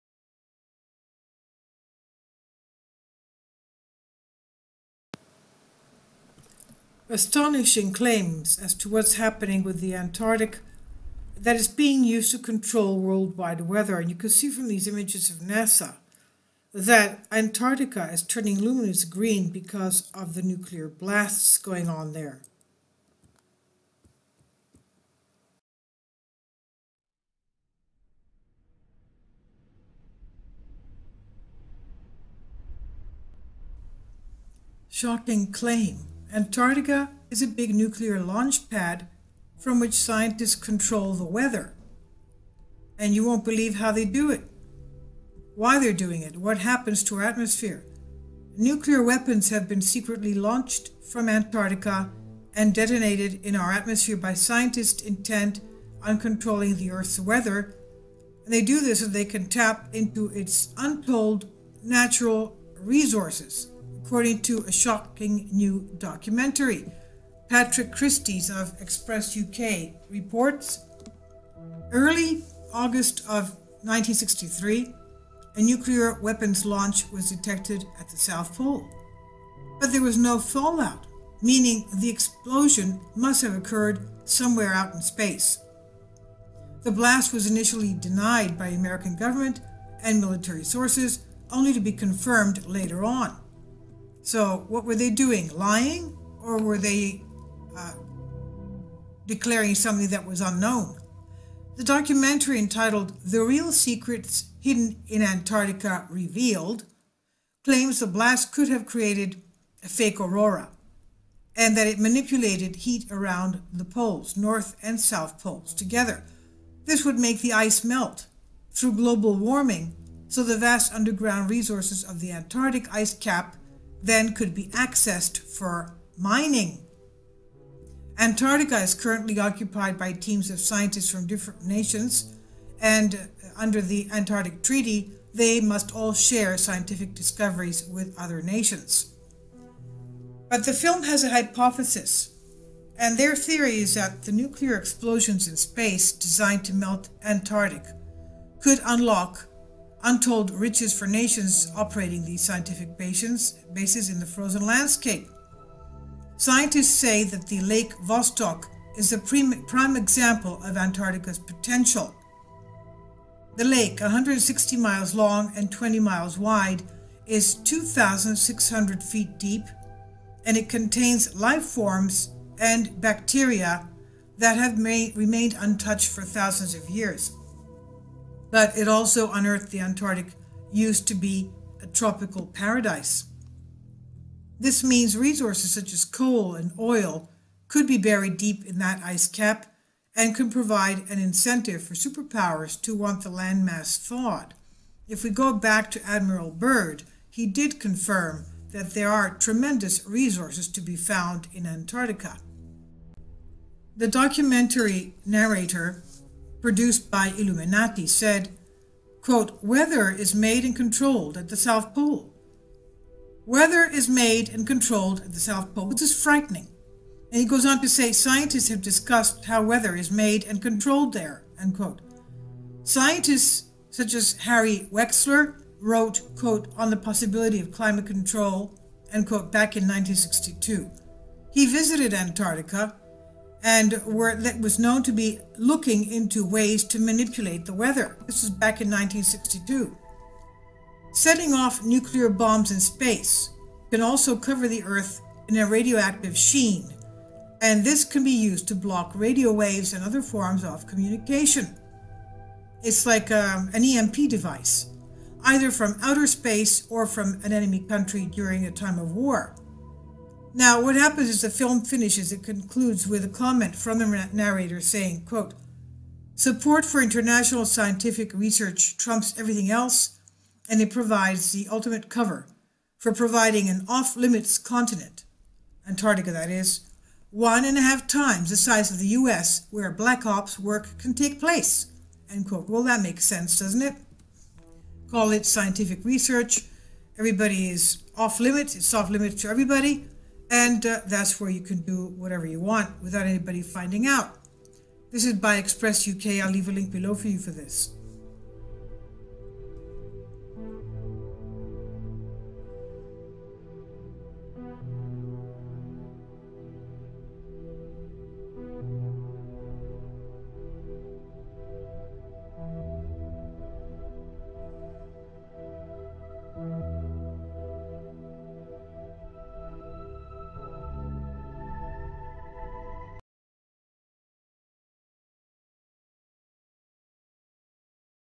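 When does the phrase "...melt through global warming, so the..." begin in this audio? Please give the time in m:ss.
1:57.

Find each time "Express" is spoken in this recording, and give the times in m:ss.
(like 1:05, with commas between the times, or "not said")
1:08, 4:55.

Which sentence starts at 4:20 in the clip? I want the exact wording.
Now, what happens is the film finishes.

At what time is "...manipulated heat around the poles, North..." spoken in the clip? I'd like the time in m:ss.
1:51.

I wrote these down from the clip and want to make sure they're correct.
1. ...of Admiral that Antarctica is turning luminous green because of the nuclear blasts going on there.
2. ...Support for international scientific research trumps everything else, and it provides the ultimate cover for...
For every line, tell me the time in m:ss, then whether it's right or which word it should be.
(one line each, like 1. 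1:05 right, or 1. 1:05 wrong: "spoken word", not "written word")
1. 0:15 wrong: "NASA", not "Admiral"
2. 4:26 right.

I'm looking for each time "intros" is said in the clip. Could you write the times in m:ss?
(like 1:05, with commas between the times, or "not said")
not said.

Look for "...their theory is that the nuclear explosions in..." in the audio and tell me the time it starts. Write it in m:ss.
2:23.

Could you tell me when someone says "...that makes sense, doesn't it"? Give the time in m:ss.
4:42.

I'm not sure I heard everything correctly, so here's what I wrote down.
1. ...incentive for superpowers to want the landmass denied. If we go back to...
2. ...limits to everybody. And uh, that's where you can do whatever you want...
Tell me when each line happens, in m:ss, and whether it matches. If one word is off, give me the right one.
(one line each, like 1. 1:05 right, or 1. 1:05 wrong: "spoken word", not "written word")
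1. 3:11 wrong: "thawed", not "denied"
2. 4:49 right.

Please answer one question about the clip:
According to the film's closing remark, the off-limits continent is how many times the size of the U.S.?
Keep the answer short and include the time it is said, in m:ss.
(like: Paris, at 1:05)
1.5 times, at 4:37.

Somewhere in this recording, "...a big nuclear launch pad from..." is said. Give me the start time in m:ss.
0:37.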